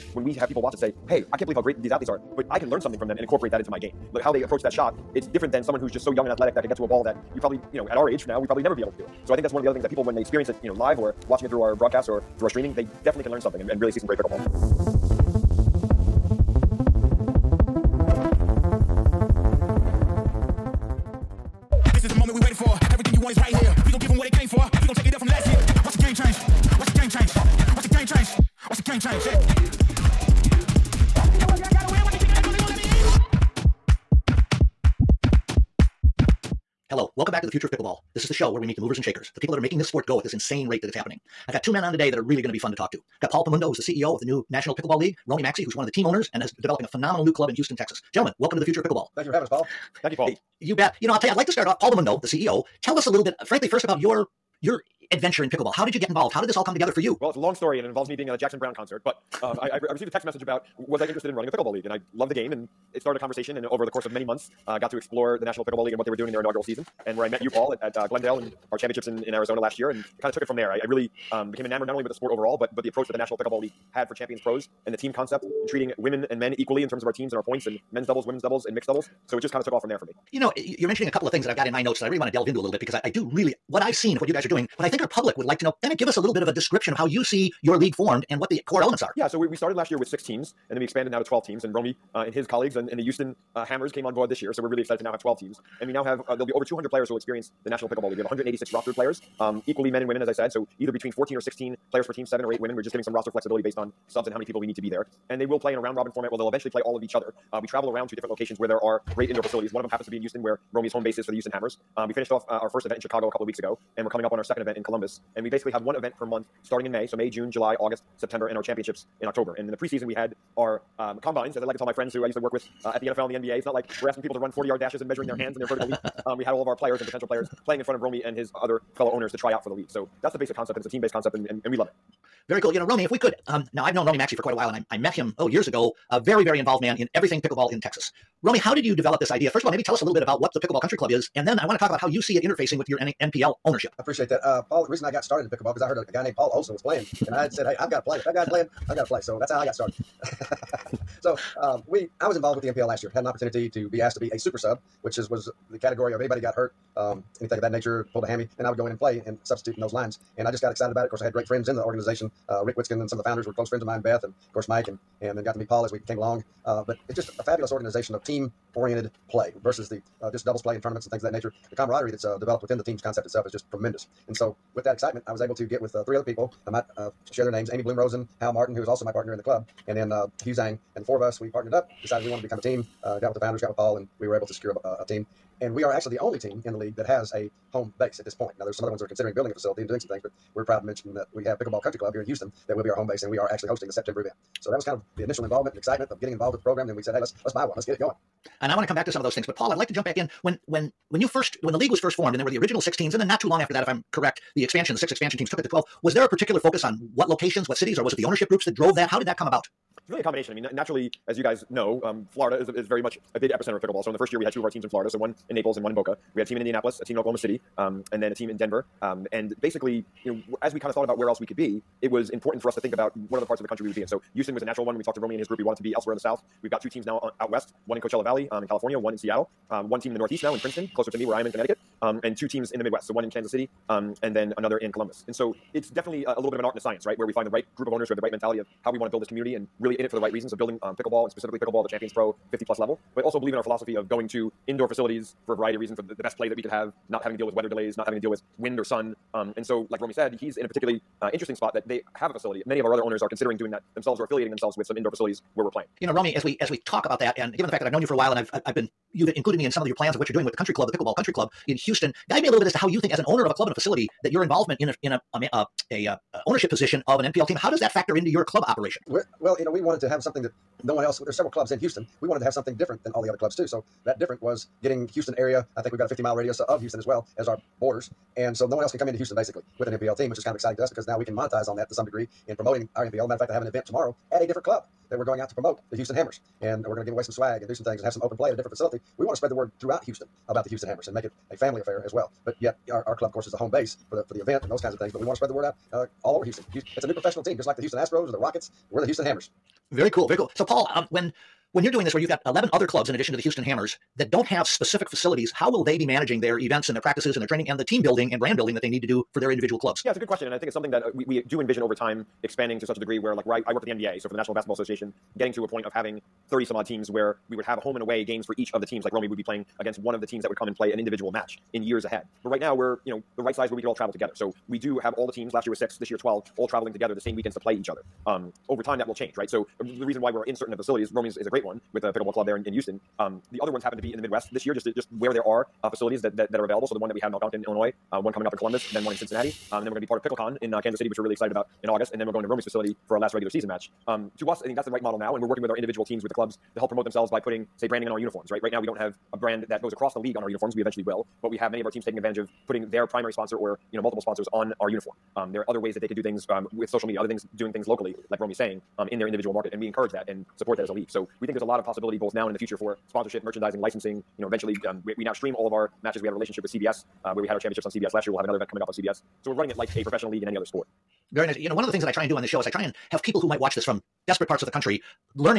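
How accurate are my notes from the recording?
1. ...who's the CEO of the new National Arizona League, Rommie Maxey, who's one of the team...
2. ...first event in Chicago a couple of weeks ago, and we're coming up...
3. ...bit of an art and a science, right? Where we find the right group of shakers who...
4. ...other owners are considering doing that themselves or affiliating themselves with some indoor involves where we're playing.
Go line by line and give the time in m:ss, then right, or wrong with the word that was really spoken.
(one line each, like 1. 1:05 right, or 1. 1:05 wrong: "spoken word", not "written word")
1. 0:43 wrong: "Pickleball", not "Arizona"
2. 1:52 right
3. 3:56 wrong: "owners", not "shakers"
4. 4:12 wrong: "facilities", not "involves".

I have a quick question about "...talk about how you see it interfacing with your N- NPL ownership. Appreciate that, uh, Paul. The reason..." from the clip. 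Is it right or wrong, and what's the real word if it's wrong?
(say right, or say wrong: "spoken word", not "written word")
right.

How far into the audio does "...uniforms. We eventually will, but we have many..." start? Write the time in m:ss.
5:50.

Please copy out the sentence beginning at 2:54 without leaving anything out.
And so, with that excitement, I was able to get with uh, three other people.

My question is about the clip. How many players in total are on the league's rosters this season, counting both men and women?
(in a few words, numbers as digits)
186.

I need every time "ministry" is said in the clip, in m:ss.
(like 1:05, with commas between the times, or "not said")
not said.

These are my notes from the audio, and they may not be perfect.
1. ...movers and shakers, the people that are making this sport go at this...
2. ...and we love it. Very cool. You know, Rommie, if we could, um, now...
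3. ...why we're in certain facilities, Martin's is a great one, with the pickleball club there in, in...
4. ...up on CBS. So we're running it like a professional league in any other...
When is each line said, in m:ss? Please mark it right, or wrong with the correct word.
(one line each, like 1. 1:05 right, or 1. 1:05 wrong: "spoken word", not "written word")
1. 0:38 right
2. 2:11 right
3. 5:30 wrong: "Rommie", not "Martin"
4. 6:08 right.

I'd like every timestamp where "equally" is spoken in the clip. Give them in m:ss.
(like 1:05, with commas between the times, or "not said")
1:16, 1:39.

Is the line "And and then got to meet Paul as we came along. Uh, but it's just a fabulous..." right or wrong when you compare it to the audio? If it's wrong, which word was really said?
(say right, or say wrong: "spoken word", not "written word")
right.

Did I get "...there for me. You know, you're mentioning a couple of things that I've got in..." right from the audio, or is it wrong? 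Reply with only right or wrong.
right.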